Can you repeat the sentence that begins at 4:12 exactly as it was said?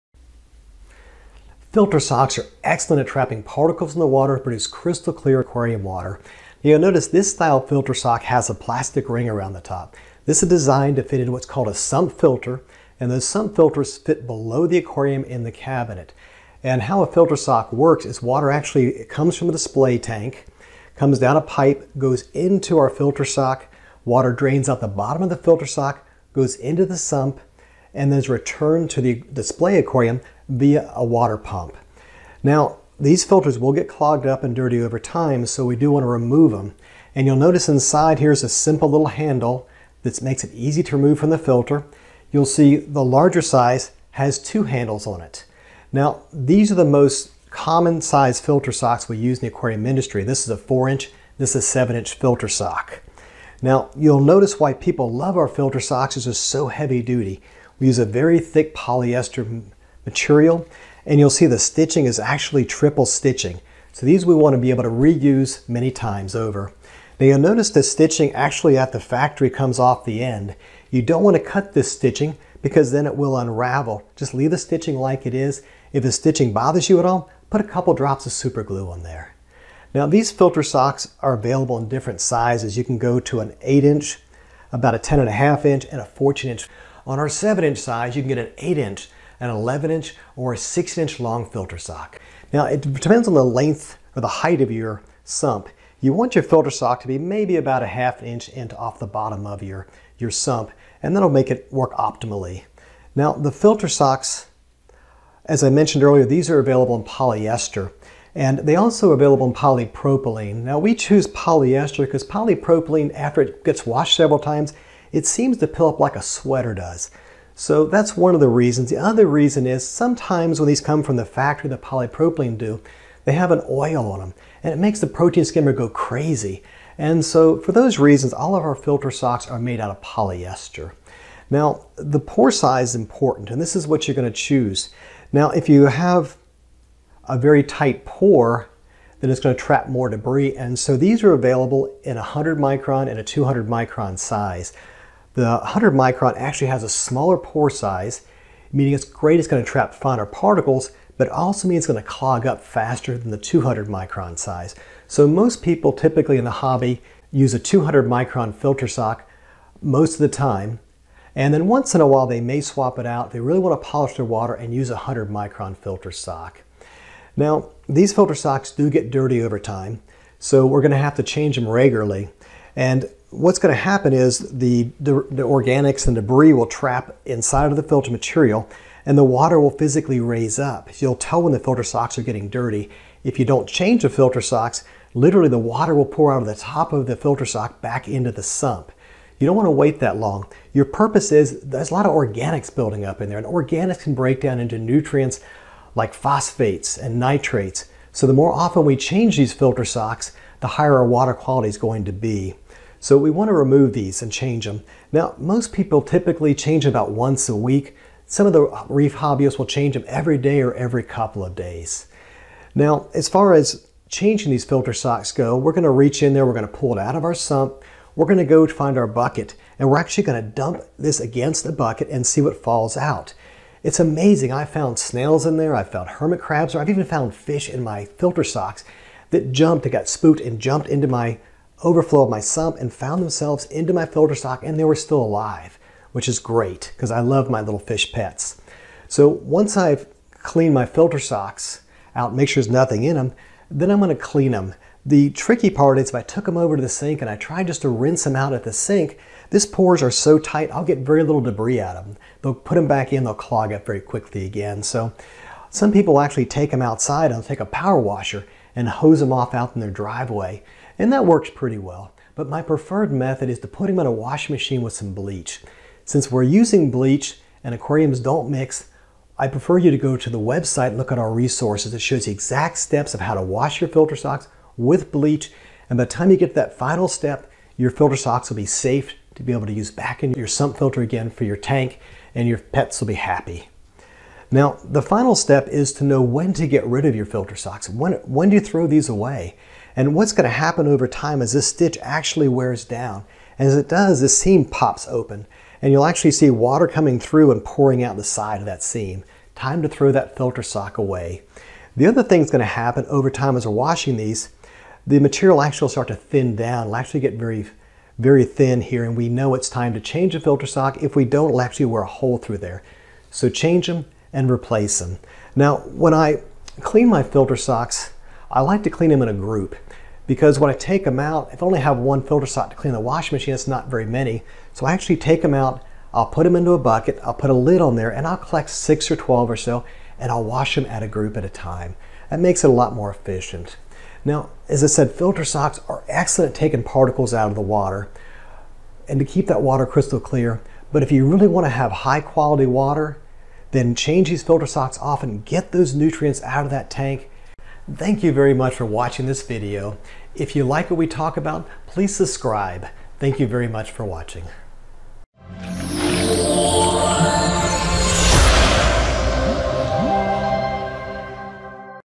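They'll put them back in, they'll clog up very quickly again.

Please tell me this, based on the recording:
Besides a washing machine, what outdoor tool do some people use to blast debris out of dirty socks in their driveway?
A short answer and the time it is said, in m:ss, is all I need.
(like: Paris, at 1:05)
Power washer, at 4:17.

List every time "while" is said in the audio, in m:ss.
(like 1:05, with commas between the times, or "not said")
2:42.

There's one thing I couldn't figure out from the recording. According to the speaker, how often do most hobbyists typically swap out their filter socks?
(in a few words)
Once a week.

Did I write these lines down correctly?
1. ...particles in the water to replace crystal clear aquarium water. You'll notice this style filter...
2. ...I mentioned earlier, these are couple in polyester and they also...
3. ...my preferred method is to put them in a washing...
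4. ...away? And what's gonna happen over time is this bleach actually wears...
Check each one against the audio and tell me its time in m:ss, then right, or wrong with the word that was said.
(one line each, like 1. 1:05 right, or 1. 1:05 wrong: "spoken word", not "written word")
1. 0:03 wrong: "produce", not "replace"
2. 1:45 wrong: "available", not "couple"
3. 4:22 right
4. 4:49 wrong: "stitch", not "bleach".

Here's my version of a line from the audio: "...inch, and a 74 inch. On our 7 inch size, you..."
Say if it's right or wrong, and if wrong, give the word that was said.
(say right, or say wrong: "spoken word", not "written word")
wrong: "14", not "74".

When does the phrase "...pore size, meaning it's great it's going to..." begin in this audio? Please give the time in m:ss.
2:27.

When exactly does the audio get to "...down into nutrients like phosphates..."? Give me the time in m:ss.
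3:14.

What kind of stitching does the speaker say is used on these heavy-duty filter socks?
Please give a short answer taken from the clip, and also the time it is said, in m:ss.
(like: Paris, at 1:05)
Triple stitching, at 1:02.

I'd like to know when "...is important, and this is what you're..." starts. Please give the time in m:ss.
2:12.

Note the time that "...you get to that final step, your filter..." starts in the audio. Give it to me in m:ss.
4:36.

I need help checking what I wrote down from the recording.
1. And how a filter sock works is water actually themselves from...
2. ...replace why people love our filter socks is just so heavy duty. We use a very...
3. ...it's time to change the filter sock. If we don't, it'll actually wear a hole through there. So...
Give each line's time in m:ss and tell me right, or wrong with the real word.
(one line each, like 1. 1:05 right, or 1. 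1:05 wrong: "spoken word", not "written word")
1. 0:16 wrong: "comes", not "themselves"
2. 0:54 wrong: "notice", not "replace"
3. 5:09 right.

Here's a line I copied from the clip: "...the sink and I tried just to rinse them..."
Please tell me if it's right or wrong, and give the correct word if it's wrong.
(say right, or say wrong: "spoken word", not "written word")
right.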